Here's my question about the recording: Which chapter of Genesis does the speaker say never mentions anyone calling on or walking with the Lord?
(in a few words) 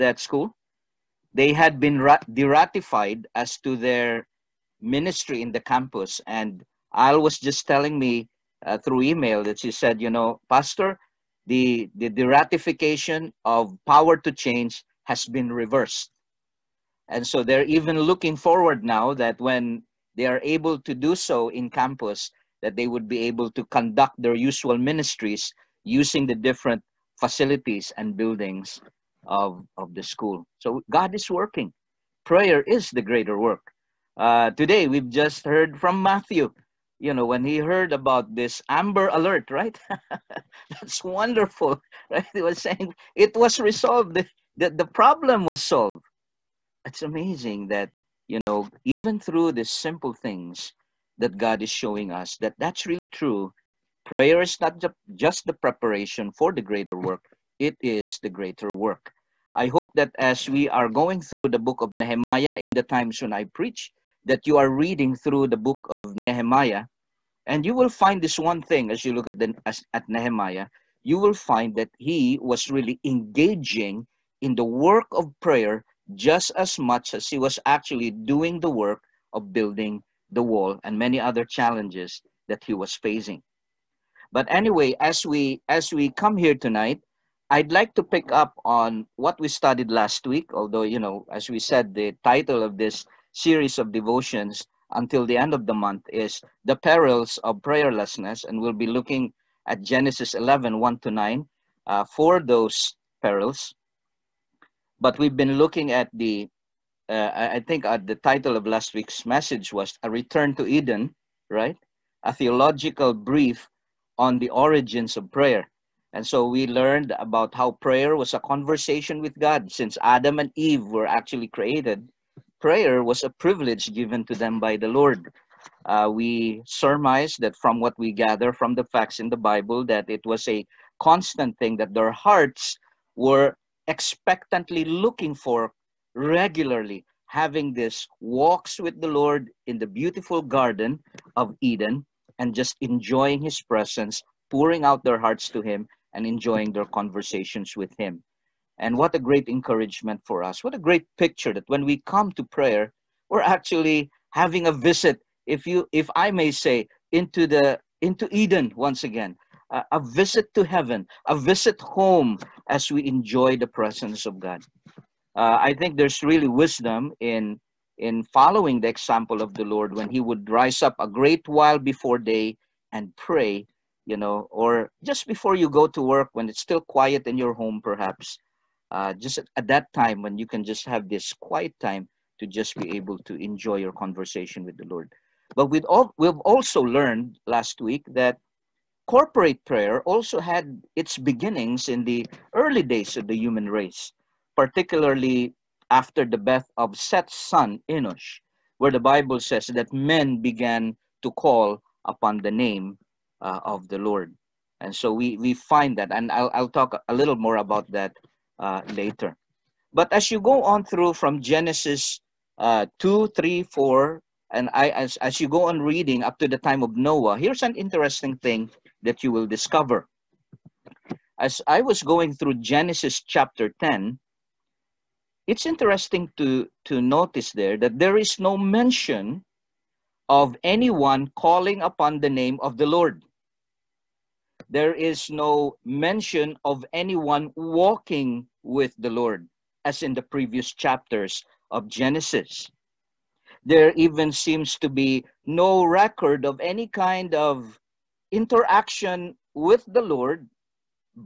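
Genesis 10.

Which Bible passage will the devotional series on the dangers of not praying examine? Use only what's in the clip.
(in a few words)
Genesis 11:1-9.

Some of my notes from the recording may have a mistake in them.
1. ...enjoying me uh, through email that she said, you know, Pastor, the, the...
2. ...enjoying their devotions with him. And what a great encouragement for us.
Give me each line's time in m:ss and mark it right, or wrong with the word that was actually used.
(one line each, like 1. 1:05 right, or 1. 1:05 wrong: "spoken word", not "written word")
1. 0:07 wrong: "telling", not "enjoying"
2. 2:26 wrong: "conversations", not "devotions".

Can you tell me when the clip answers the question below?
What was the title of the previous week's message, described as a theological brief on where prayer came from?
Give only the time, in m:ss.
1:50.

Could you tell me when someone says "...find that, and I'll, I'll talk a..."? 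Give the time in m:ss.
3:25.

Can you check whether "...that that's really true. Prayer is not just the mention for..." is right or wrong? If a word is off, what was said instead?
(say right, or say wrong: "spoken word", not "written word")
wrong: "preparation", not "mention".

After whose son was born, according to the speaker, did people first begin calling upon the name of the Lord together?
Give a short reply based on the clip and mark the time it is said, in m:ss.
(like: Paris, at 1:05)
Enosh, at 3:17.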